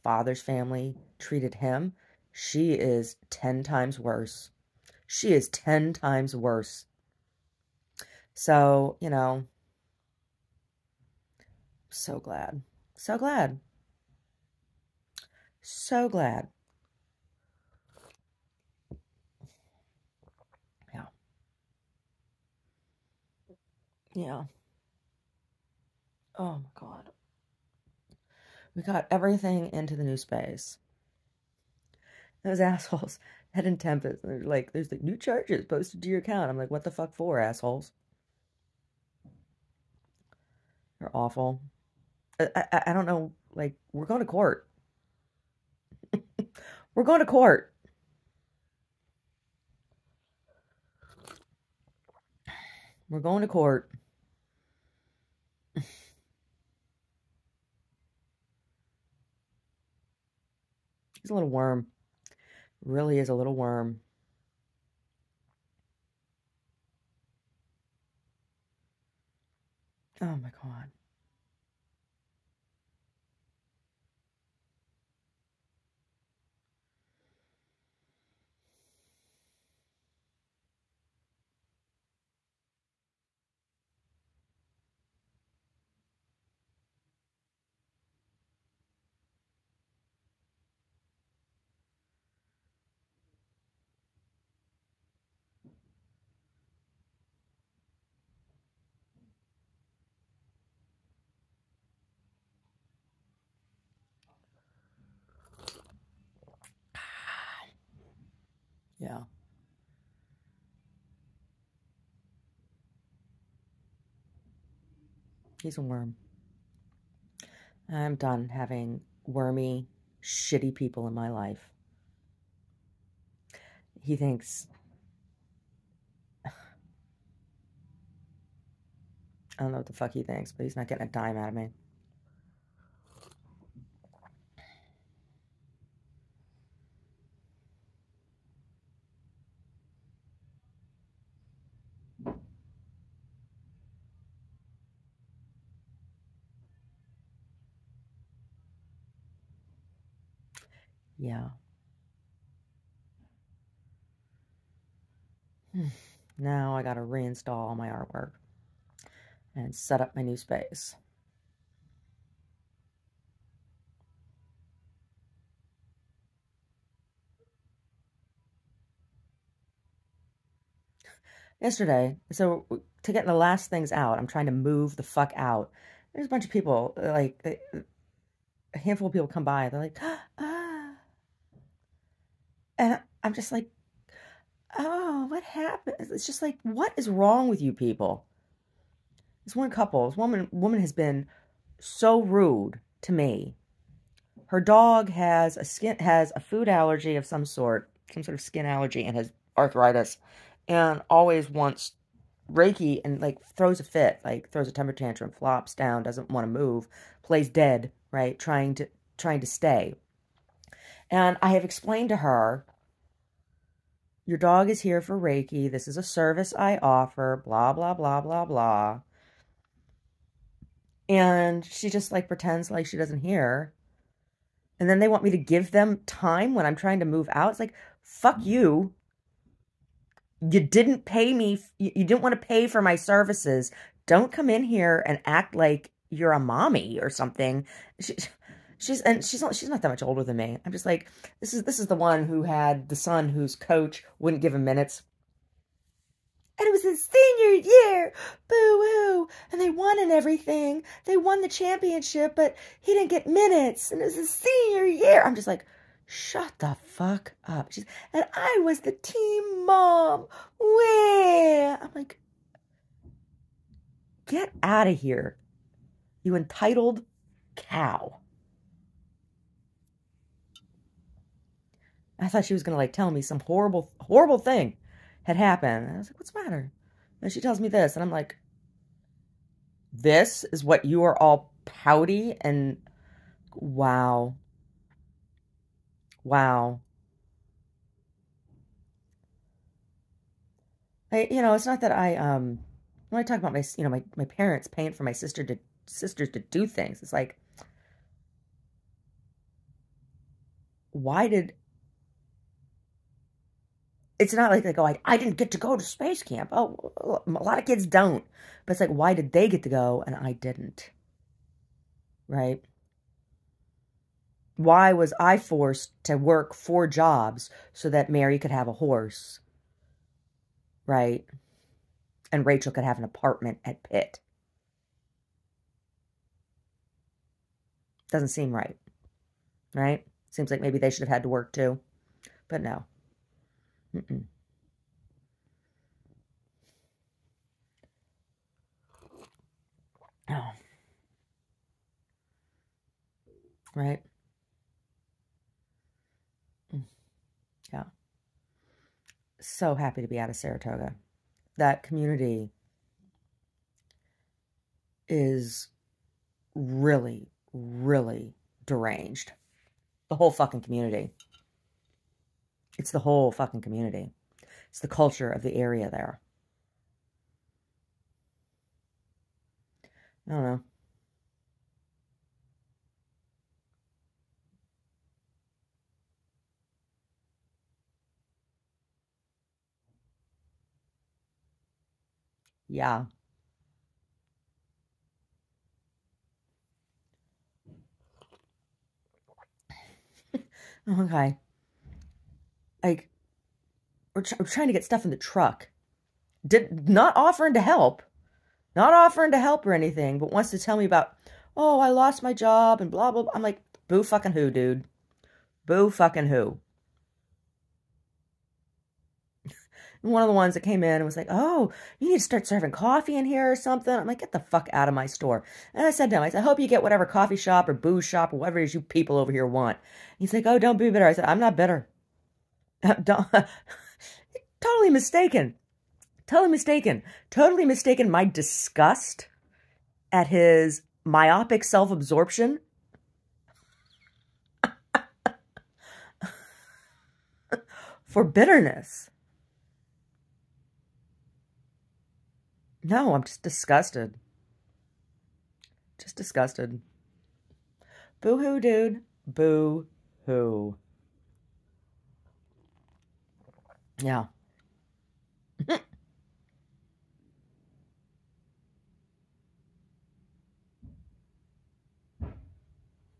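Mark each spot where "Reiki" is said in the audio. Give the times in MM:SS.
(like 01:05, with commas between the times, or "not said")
03:22, 03:35.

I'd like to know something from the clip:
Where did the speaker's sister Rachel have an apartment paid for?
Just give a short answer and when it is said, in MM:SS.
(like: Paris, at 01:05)
Pitt, at 05:23.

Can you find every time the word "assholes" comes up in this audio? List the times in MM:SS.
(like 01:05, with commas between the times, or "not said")
00:32, 00:37.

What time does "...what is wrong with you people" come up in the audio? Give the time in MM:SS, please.
03:06.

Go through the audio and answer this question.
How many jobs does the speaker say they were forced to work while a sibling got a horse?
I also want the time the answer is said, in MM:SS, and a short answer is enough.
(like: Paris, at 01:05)
4, at 05:16.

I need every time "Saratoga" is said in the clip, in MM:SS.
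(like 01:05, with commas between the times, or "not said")
05:50.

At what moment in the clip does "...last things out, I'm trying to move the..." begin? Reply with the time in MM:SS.
02:53.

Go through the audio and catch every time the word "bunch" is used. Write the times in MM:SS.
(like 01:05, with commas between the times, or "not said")
02:56.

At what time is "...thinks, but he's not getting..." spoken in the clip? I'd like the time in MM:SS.
02:10.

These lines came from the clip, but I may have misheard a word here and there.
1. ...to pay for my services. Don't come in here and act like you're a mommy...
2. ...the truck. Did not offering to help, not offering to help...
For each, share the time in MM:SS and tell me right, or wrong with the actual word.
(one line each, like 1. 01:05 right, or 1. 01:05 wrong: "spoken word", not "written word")
1. 03:52 right
2. 06:35 right.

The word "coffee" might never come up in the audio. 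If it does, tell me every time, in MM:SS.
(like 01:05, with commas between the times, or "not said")
06:52, 06:57.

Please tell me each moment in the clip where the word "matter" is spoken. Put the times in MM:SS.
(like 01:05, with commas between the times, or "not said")
04:36.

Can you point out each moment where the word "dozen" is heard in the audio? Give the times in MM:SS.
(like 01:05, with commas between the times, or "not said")
not said.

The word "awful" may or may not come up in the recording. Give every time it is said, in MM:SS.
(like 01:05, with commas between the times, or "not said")
00:41.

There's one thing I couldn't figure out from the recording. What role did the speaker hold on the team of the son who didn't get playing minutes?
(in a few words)
team mom.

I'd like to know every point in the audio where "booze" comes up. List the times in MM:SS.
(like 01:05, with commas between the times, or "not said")
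06:57.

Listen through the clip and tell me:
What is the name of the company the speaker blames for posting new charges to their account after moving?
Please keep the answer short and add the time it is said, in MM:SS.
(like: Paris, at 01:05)
Tempest, at 00:33.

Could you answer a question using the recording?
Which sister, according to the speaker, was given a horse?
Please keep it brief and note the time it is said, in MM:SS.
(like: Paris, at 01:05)
Mary, at 05:18.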